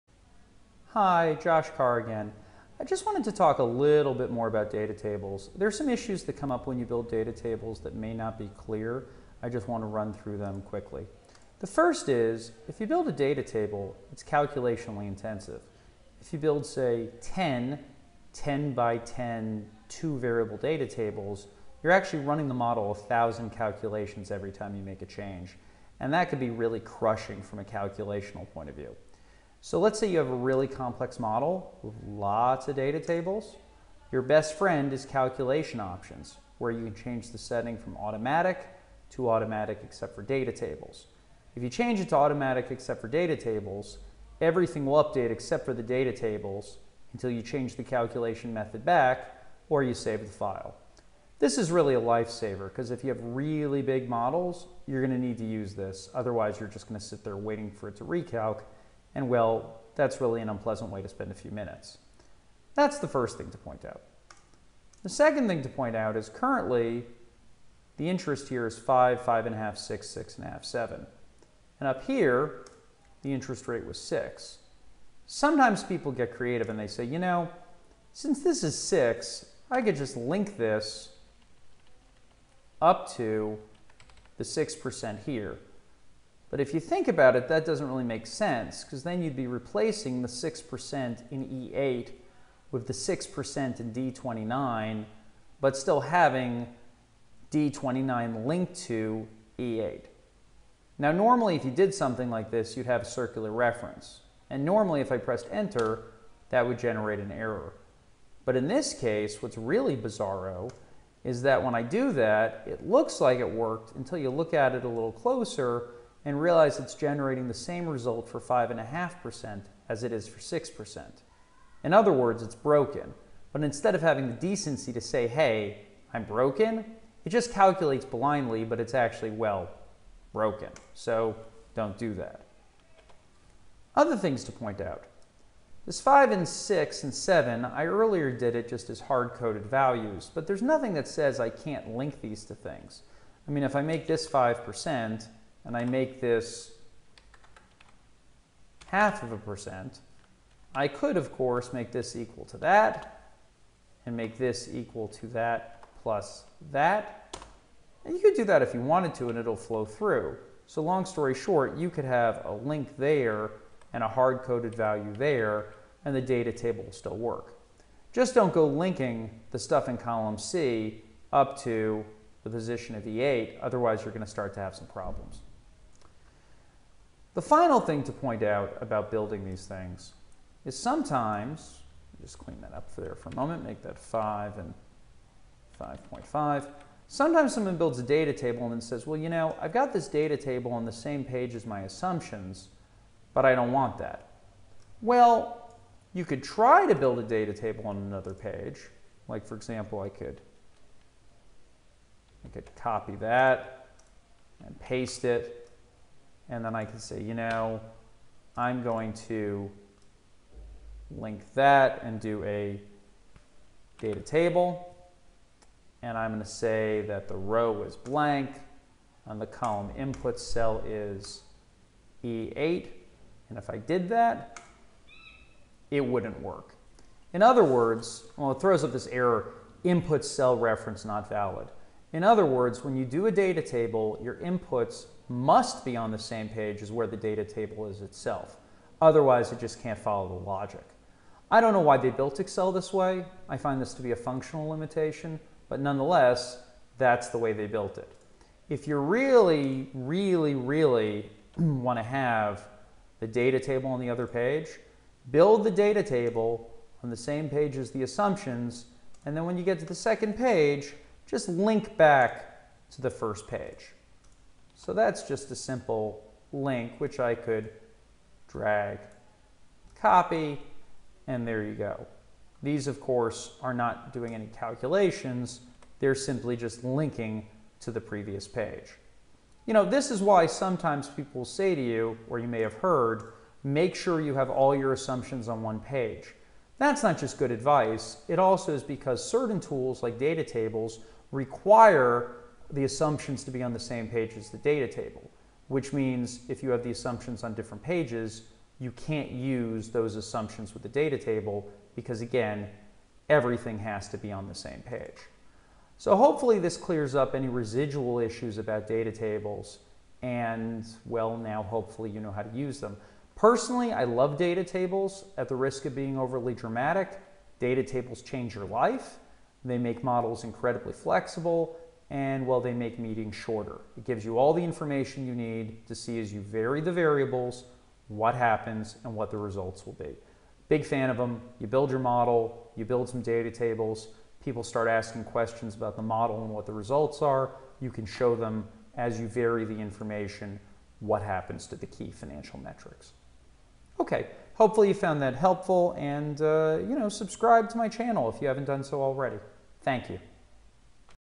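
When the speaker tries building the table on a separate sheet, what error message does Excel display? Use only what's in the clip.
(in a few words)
input cell reference not valid.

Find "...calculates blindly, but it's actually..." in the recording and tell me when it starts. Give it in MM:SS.
02:07.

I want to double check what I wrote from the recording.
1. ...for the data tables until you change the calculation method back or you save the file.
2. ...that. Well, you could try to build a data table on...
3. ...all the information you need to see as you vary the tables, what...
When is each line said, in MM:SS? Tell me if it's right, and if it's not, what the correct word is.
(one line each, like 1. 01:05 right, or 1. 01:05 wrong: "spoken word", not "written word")
1. 00:45 right
2. 03:13 right
3. 05:24 wrong: "variables", not "tables".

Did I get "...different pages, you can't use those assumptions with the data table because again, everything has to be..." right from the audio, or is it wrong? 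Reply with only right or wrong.
right.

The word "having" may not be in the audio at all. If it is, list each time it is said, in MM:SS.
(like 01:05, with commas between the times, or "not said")
01:36, 02:04.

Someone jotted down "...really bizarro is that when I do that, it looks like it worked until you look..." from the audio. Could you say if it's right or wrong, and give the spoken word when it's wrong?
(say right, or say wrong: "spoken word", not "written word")
right.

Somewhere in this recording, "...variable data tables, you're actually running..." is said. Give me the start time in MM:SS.
00:20.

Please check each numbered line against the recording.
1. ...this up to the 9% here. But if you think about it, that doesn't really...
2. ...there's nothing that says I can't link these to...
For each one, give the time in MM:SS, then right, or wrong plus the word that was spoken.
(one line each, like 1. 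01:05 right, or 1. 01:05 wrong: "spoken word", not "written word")
1. 01:20 wrong: "6", not "9"
2. 02:20 right.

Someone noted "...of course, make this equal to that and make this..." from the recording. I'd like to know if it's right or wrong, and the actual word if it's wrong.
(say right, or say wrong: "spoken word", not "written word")
right.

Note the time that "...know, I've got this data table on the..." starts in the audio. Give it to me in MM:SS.
03:09.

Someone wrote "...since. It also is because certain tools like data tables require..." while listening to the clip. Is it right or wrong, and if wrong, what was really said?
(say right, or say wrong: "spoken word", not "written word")
wrong: "advice", not "since".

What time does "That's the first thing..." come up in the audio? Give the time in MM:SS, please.
01:02.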